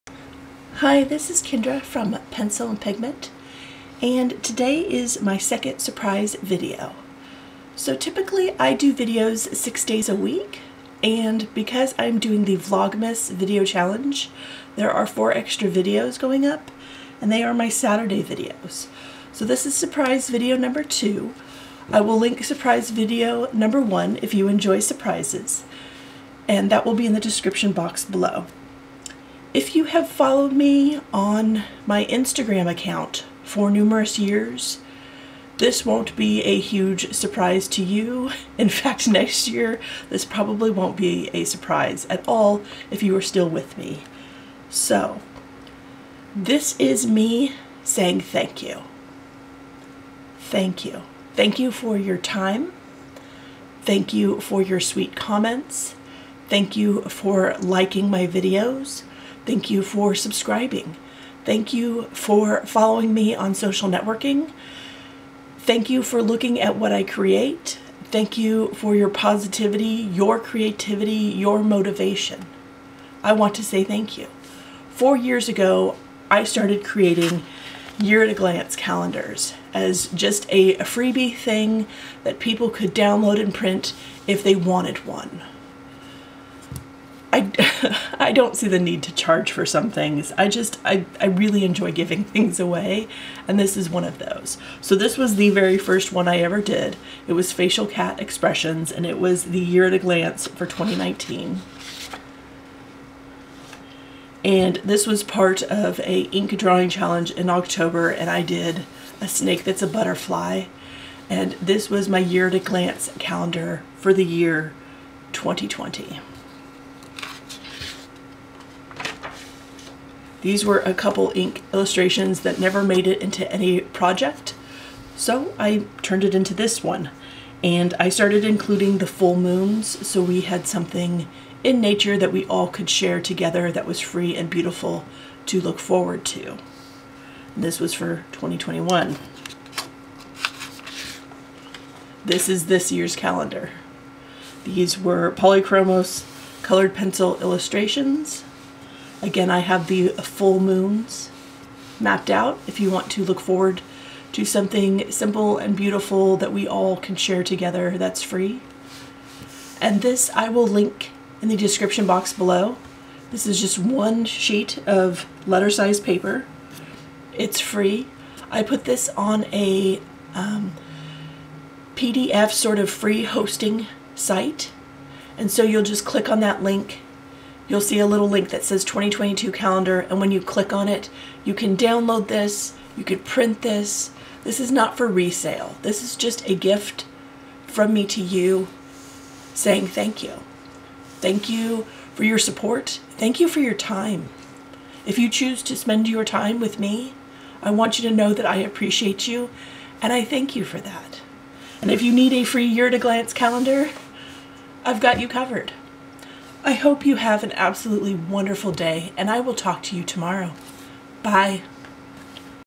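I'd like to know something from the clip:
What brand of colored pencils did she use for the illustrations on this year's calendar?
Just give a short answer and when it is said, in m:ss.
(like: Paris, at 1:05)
Polychromos, at 2:25.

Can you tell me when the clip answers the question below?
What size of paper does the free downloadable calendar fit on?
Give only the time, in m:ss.
2:45.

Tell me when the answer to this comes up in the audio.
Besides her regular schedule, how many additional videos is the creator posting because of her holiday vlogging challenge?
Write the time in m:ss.
0:15.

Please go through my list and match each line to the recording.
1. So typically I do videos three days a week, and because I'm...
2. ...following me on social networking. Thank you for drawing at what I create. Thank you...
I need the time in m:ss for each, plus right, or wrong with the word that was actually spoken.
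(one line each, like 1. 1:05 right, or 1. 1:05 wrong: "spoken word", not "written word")
1. 0:07 wrong: "six", not "three"
2. 1:02 wrong: "looking", not "drawing".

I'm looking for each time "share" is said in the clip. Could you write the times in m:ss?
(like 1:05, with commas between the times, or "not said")
2:12, 2:37.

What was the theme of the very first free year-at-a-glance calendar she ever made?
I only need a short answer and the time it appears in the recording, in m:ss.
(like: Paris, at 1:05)
Facial Cat Expressions, at 1:37.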